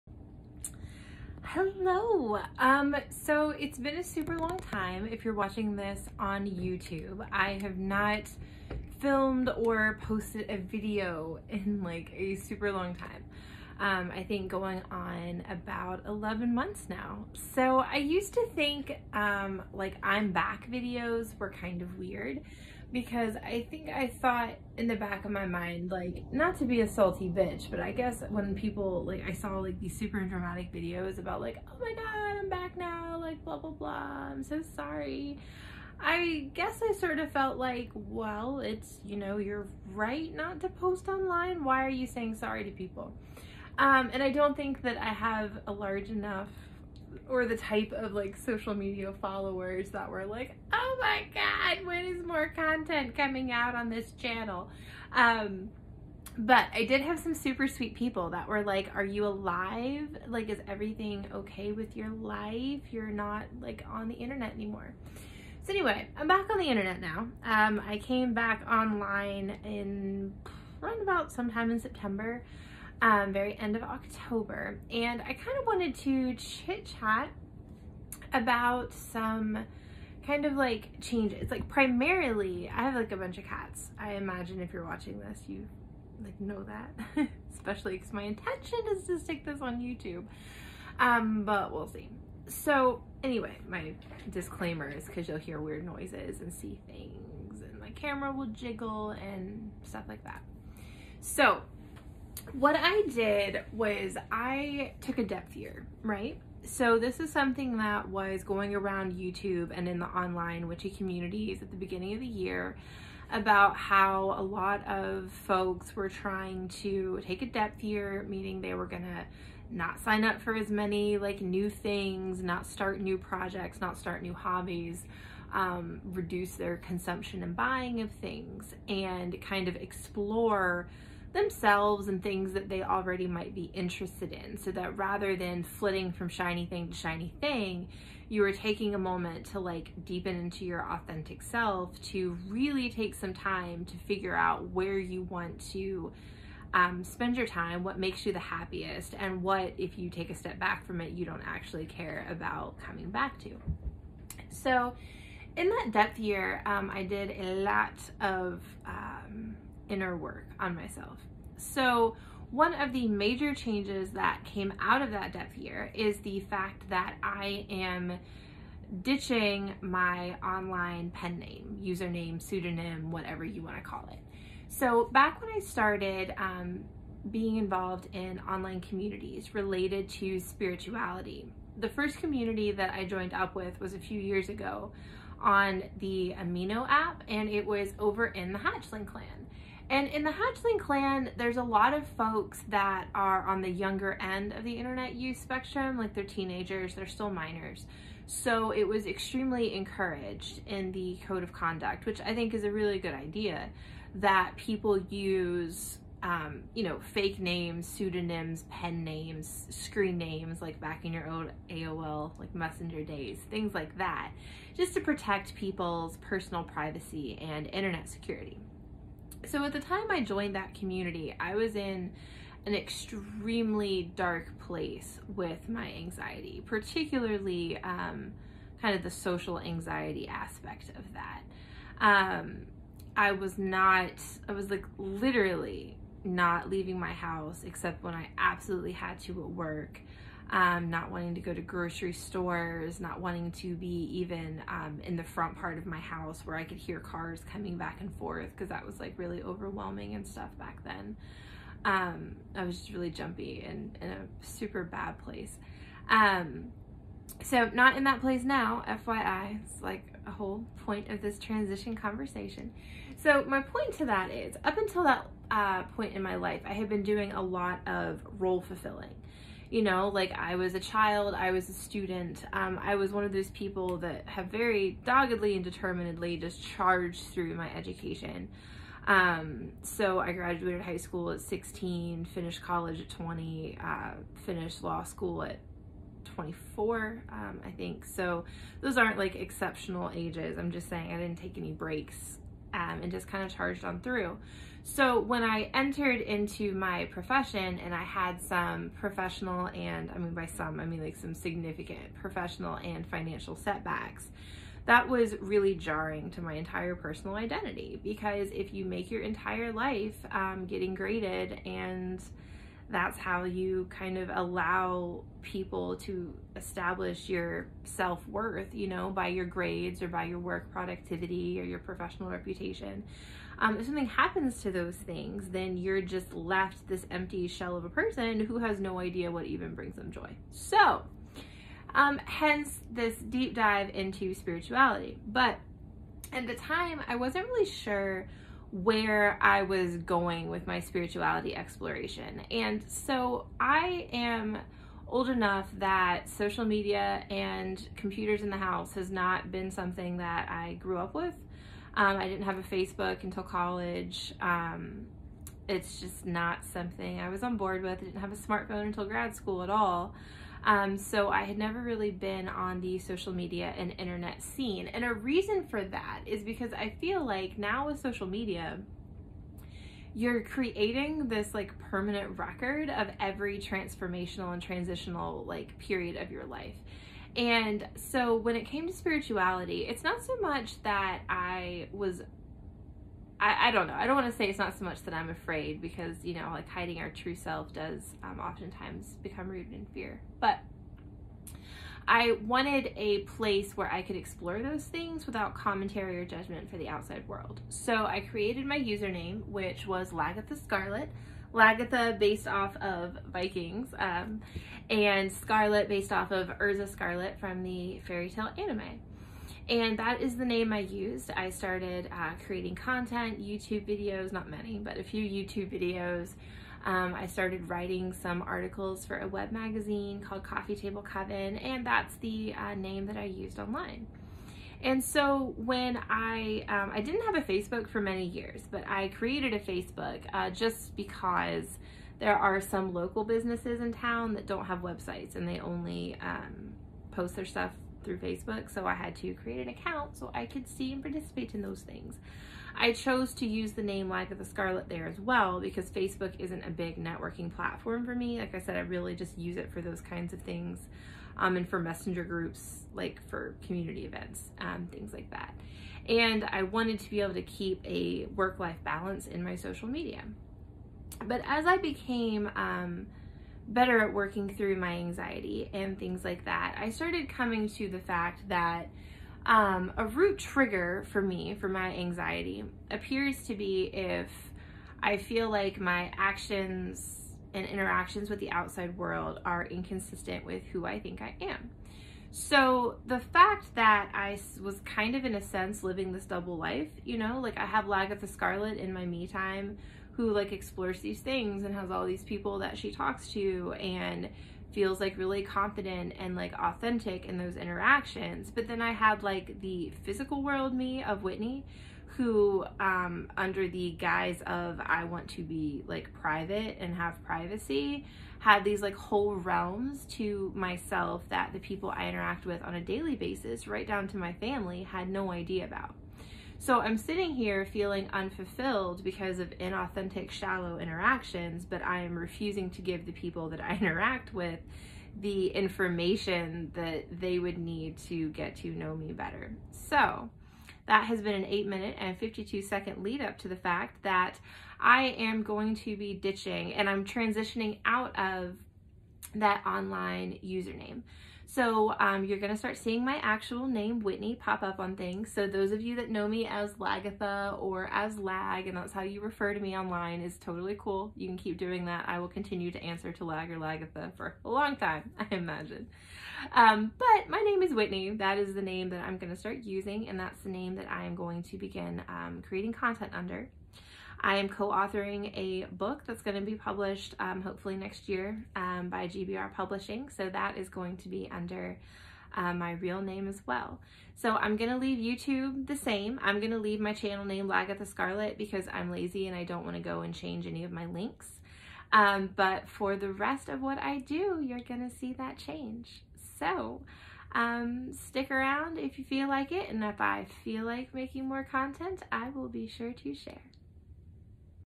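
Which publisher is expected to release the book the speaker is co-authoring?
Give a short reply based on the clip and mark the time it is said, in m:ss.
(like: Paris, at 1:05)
GBR Publishing, at 9:29.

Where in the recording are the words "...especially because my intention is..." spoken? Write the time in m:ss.
1:27.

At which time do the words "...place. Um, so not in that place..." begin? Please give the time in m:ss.
4:15.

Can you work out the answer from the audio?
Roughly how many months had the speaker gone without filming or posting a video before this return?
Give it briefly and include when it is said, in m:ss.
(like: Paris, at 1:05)
11, at 0:16.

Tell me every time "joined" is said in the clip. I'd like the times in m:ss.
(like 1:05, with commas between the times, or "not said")
3:03, 3:40.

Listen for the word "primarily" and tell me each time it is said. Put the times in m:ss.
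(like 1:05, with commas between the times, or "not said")
1:21.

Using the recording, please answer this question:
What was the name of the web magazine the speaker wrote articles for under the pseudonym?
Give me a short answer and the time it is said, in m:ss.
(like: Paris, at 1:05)
Coffee Table Coven, at 7:00.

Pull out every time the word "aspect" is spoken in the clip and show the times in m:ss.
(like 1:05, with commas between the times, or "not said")
3:50.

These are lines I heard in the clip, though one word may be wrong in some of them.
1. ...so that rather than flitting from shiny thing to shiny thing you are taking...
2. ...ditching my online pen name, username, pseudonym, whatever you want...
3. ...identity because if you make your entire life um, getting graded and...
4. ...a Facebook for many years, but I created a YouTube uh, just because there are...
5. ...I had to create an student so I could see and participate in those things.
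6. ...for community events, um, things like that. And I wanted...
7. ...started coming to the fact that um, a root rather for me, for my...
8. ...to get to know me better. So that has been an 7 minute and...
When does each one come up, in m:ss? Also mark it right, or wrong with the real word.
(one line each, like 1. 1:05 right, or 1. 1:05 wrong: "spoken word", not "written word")
1. 2:14 right
2. 2:49 right
3. 5:07 right
4. 7:07 wrong: "Facebook", not "YouTube"
5. 7:18 wrong: "account", not "student"
6. 7:33 right
7. 7:46 wrong: "trigger", not "rather"
8. 8:48 wrong: "8", not "7".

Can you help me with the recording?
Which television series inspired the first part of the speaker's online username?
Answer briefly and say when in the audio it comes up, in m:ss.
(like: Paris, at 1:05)
Vikings, at 6:43.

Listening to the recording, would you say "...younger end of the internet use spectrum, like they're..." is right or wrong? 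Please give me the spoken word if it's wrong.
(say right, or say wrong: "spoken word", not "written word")
right.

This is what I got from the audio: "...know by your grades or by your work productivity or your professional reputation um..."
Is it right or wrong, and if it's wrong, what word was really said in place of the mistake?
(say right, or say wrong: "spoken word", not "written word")
right.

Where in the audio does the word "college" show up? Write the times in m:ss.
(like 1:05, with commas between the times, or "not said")
4:42, 5:53.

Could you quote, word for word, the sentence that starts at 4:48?
So those aren't like exceptional ages.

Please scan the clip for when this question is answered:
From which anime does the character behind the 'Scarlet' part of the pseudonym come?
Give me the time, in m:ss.
6:48.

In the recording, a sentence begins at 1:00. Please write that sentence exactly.
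Like, is everything okay with your life?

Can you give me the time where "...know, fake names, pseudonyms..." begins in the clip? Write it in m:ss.
3:26.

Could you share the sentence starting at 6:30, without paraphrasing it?
But I wanted a place where I could explore those things without commentary or judgment for the outside world.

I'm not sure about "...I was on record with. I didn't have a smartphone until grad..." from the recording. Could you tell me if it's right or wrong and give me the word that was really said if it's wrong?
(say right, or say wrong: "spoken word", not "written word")
wrong: "board", not "record".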